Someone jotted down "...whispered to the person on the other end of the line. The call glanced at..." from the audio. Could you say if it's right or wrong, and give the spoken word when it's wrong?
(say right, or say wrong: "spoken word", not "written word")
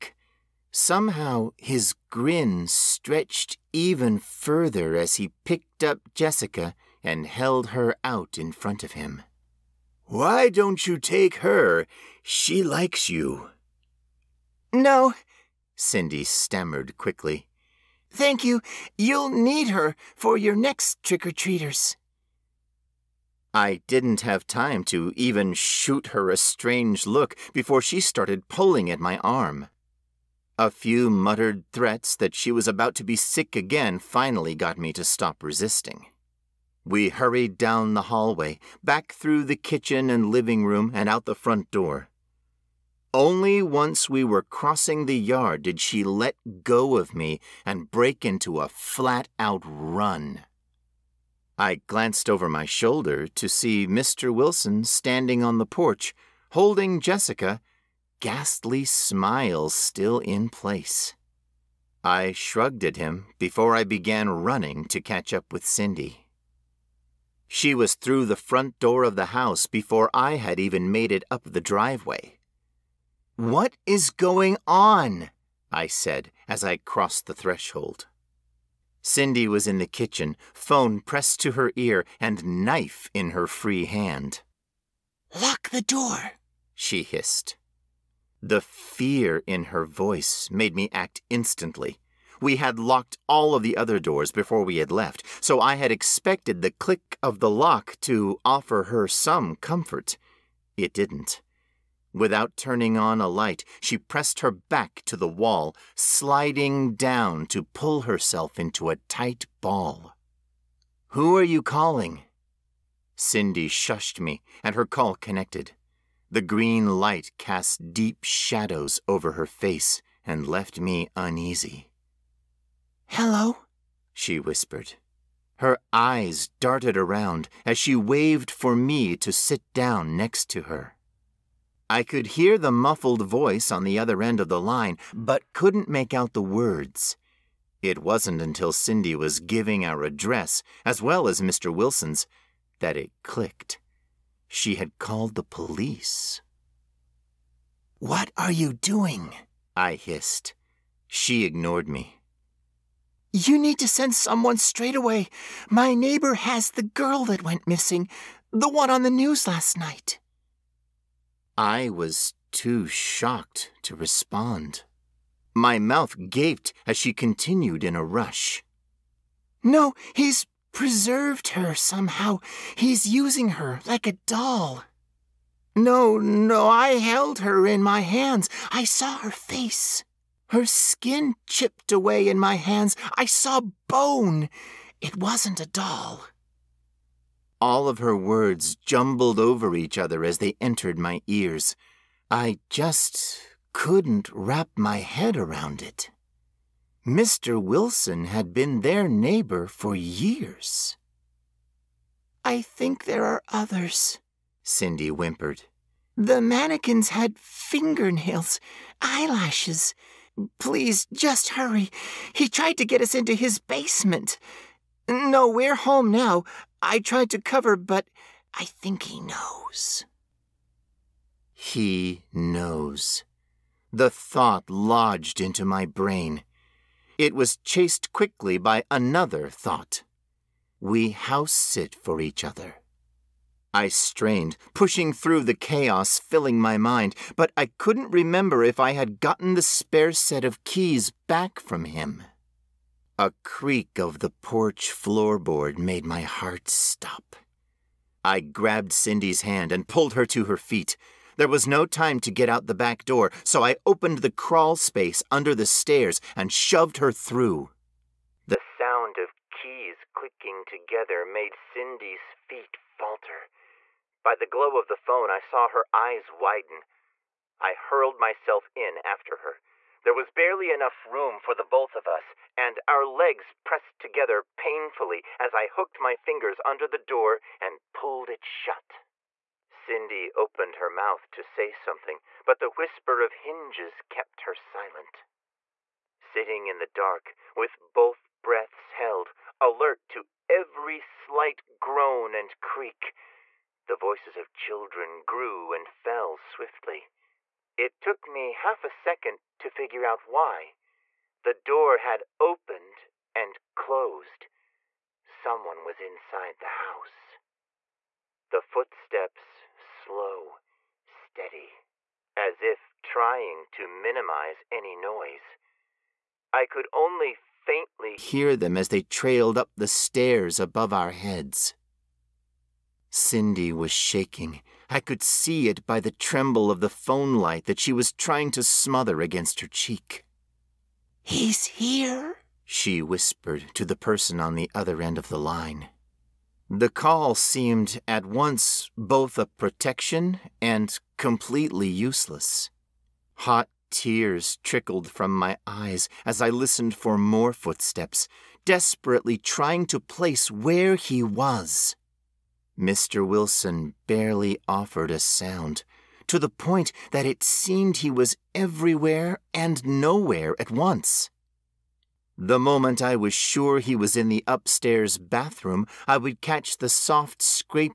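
wrong: "seemed", not "glanced".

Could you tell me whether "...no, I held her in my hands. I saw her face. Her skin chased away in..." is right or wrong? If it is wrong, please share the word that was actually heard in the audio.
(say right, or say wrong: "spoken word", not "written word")
wrong: "chipped", not "chased".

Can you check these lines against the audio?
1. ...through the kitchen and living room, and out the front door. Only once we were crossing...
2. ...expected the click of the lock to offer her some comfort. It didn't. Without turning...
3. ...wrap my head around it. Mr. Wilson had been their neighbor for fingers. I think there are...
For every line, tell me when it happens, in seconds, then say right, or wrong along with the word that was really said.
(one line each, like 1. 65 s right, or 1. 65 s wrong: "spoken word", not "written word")
1. 39 s right
2. 95 s right
3. 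194 s wrong: "years", not "fingers".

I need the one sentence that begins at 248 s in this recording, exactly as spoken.
I grabbed Cindy's hand and pulled her to her feet.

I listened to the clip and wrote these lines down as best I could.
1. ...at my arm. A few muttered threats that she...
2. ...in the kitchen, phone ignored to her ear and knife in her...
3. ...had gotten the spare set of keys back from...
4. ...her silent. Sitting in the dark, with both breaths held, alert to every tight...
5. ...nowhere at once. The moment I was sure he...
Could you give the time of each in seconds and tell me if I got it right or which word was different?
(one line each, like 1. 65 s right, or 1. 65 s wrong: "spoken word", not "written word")
1. 28 s right
2. 79 s wrong: "pressed", not "ignored"
3. 238 s right
4. 284 s wrong: "slight", not "tight"
5. 359 s right.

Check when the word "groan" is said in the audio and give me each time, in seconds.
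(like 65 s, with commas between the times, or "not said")
291 s.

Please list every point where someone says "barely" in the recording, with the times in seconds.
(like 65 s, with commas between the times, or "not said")
270 s, 354 s.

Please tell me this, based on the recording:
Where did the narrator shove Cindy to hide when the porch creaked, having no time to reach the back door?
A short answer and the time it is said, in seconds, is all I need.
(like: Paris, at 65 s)
crawl space under the stairs, at 254 s.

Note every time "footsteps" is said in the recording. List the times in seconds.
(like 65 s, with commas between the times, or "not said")
308 s, 347 s.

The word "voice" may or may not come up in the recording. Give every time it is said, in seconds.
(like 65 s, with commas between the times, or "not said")
89 s, 133 s, 293 s.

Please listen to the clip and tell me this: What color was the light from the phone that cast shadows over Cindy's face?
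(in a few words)
green.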